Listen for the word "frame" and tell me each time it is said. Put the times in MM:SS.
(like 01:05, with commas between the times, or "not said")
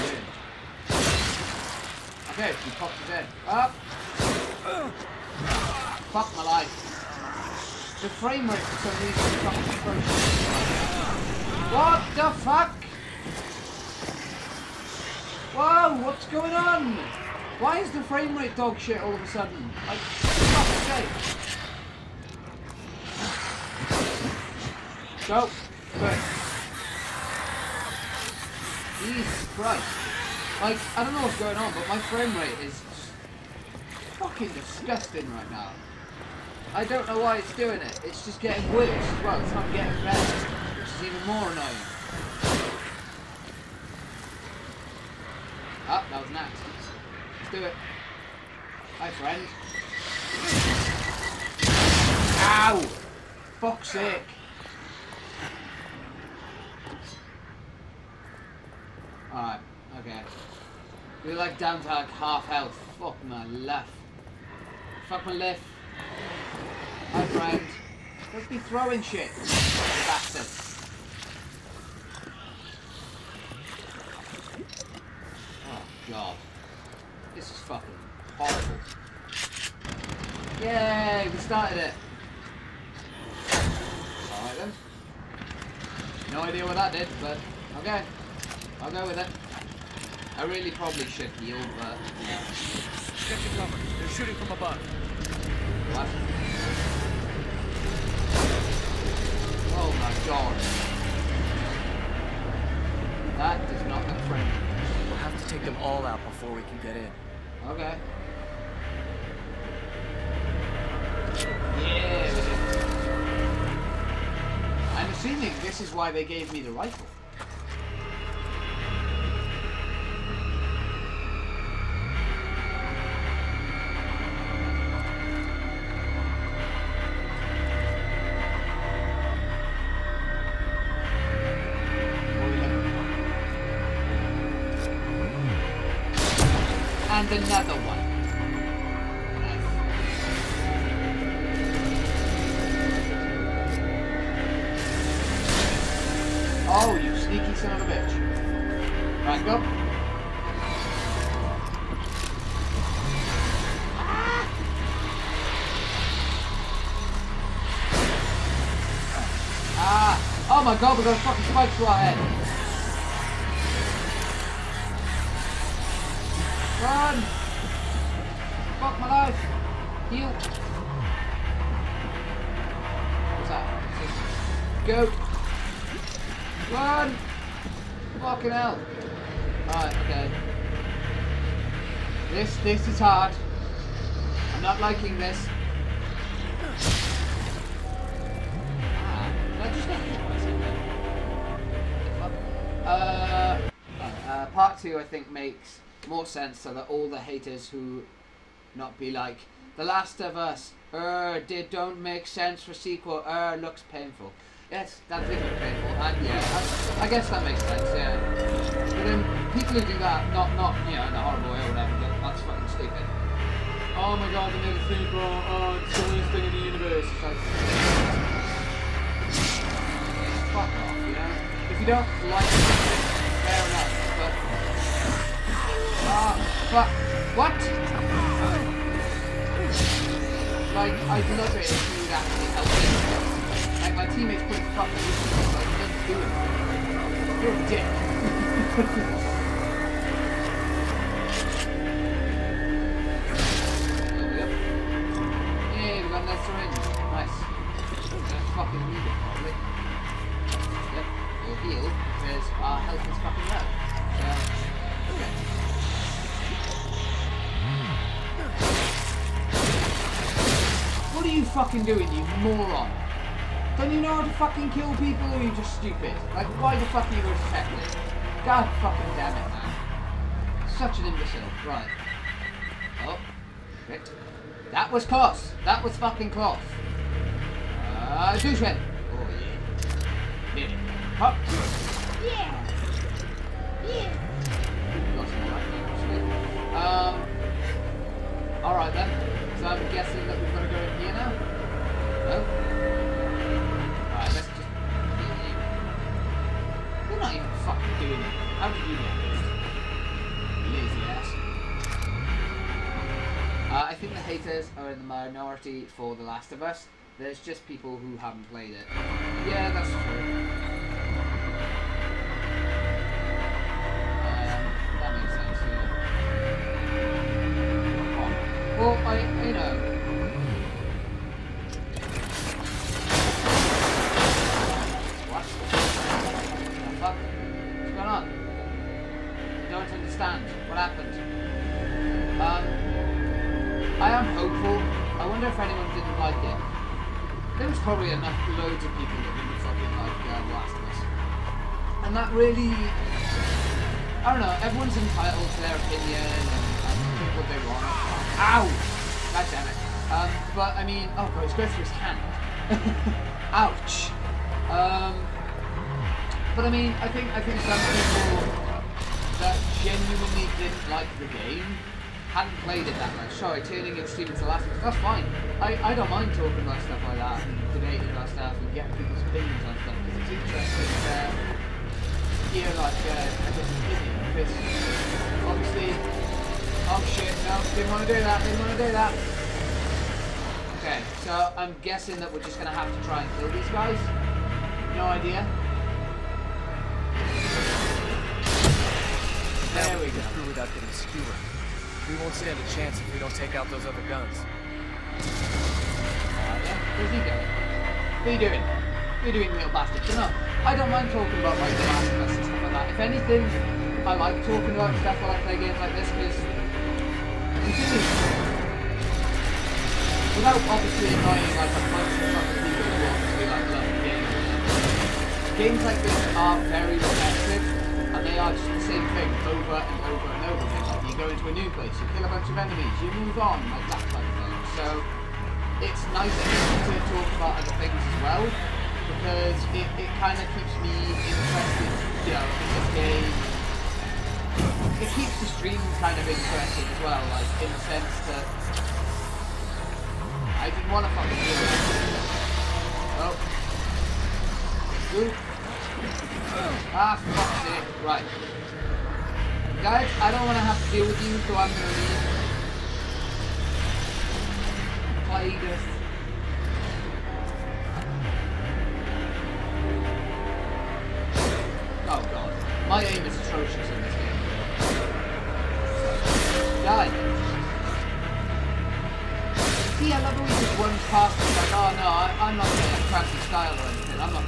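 00:08, 00:18, 00:31.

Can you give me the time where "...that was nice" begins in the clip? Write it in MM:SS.
00:46.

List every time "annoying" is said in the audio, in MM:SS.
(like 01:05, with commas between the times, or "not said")
00:41, 06:51.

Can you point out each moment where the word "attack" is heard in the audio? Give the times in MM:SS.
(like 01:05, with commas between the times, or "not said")
04:27.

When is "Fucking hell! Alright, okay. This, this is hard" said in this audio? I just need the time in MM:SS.
02:58.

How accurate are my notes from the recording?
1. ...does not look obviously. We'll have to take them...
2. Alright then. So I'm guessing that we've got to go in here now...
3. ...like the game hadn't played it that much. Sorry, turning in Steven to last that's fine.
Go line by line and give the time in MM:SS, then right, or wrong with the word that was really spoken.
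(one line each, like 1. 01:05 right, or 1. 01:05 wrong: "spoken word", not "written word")
1. 01:43 wrong: "friendly", not "obviously"
2. 04:48 right
3. 06:00 right.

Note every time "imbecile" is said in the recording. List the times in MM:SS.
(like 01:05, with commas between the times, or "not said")
04:31.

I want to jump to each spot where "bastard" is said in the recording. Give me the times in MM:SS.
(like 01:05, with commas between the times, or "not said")
01:10, 06:39.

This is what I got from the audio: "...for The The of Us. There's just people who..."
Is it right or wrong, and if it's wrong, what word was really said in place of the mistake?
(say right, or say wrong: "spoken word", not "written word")
wrong: "Last", not "The".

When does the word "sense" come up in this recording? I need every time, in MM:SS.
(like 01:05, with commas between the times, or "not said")
03:16, 03:22, 03:27, 07:17.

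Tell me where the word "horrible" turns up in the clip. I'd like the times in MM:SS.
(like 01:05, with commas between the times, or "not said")
01:18, 03:31.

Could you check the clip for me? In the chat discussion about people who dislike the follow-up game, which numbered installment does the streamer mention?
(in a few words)
Part two.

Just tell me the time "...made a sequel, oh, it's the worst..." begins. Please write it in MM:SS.
03:34.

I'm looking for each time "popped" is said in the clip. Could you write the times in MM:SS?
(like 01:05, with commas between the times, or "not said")
00:02.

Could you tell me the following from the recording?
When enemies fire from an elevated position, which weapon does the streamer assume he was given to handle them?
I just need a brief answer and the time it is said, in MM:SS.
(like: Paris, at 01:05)
The rifle, at 01:56.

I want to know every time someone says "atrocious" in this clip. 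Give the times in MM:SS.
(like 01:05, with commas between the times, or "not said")
00:09, 07:43.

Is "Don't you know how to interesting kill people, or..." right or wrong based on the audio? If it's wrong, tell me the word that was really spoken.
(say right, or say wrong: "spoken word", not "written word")
wrong: "fucking", not "interesting".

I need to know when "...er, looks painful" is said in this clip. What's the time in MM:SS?
03:23.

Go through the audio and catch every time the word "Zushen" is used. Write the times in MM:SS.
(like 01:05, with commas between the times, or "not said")
04:38.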